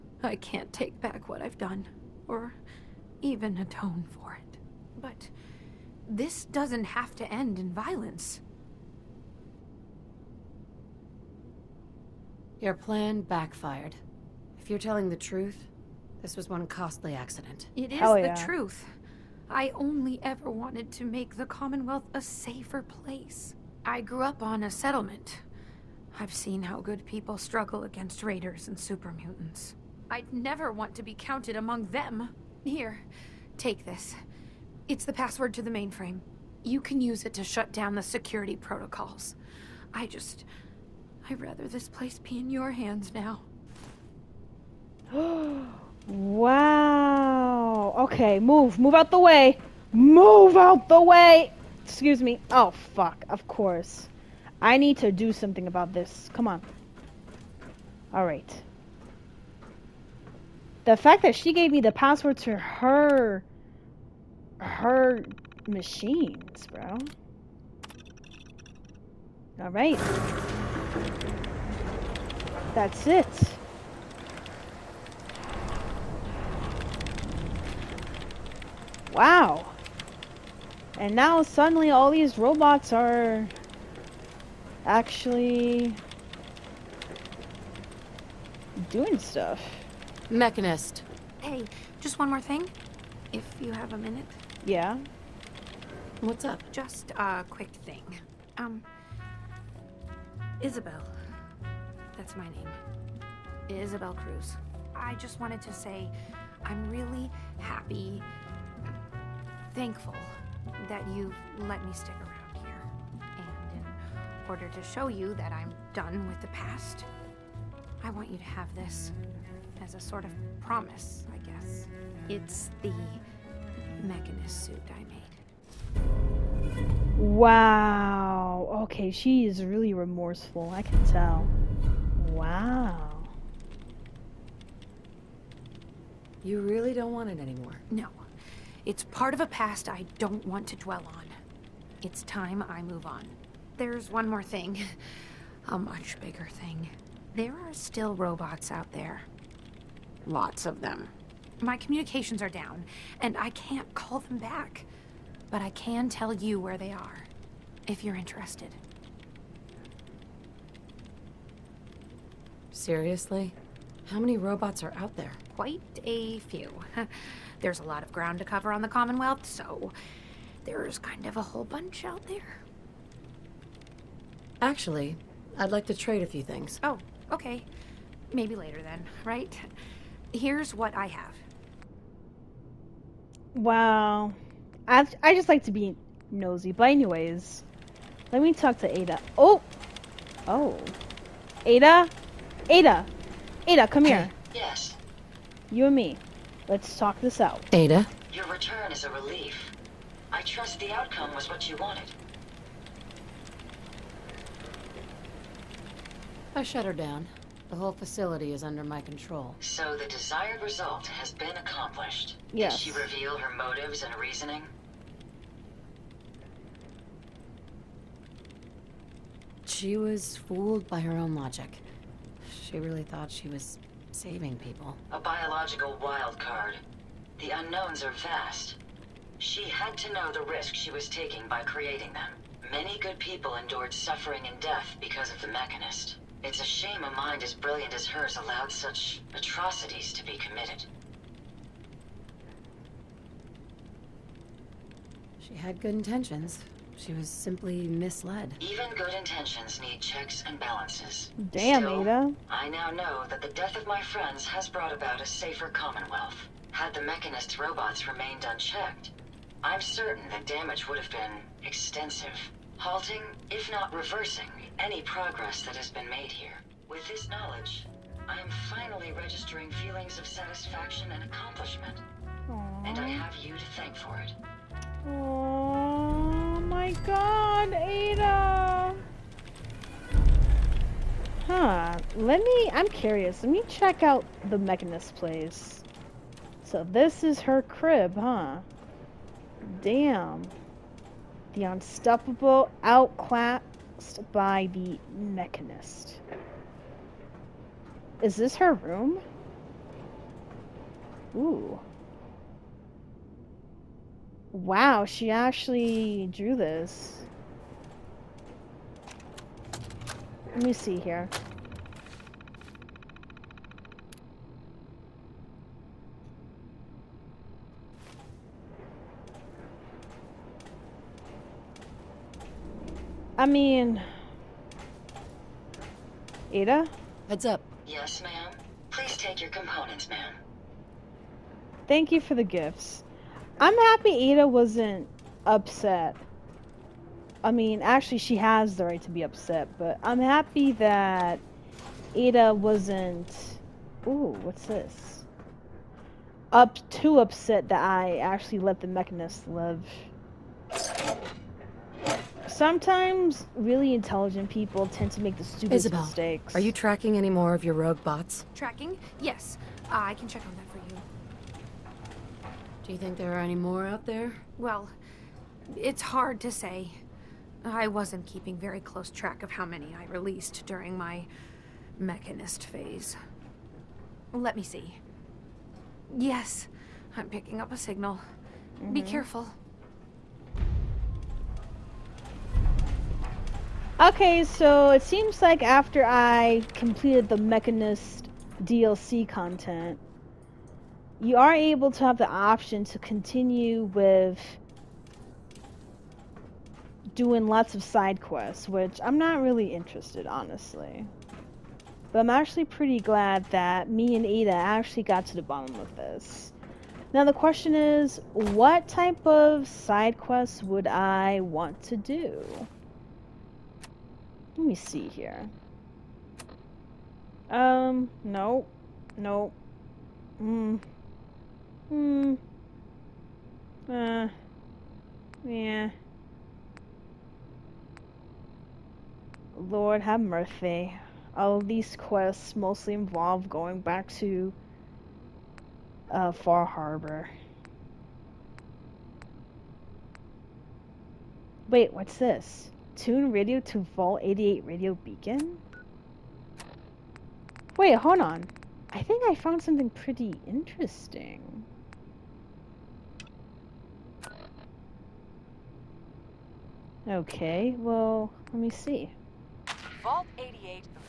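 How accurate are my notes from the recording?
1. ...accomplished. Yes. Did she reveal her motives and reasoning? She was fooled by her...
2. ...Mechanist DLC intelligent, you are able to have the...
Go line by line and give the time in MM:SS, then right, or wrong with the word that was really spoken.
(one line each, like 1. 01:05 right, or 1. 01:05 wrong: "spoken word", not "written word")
1. 03:31 right
2. 06:27 wrong: "content", not "intelligent".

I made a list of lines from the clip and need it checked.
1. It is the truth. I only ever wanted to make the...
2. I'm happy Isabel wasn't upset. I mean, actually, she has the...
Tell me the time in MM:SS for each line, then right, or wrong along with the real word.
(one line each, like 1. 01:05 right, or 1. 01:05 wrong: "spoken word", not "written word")
1. 00:17 right
2. 05:33 wrong: "Ada", not "Isabel".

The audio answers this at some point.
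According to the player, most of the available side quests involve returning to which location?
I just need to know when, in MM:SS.
07:16.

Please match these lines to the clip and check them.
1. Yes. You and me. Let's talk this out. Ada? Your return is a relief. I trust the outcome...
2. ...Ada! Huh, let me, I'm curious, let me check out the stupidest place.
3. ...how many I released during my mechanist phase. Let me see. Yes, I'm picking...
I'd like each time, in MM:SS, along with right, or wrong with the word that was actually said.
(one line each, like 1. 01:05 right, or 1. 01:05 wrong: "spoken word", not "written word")
1. 03:14 right
2. 04:37 wrong: "mechanist", not "stupidest"
3. 06:09 right.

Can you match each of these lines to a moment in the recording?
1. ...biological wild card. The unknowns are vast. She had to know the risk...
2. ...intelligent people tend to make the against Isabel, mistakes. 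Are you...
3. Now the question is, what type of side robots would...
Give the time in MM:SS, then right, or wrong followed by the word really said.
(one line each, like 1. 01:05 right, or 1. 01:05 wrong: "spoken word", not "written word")
1. 03:45 right
2. 05:53 wrong: "stupidest", not "against"
3. 06:47 wrong: "quests", not "robots".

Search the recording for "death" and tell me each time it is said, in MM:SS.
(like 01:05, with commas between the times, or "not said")
03:54, 04:13.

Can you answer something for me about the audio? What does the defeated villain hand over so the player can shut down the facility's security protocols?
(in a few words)
The password to the mainframe.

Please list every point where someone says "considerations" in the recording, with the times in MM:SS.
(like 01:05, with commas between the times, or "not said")
not said.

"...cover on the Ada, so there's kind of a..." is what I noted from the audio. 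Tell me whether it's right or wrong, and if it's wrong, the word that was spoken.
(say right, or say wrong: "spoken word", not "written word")
wrong: "Commonwealth", not "Ada".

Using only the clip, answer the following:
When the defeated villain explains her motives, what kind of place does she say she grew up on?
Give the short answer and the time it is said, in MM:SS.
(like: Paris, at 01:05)
A settlement, at 00:24.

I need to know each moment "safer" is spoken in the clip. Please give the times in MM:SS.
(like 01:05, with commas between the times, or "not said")
00:22, 04:15.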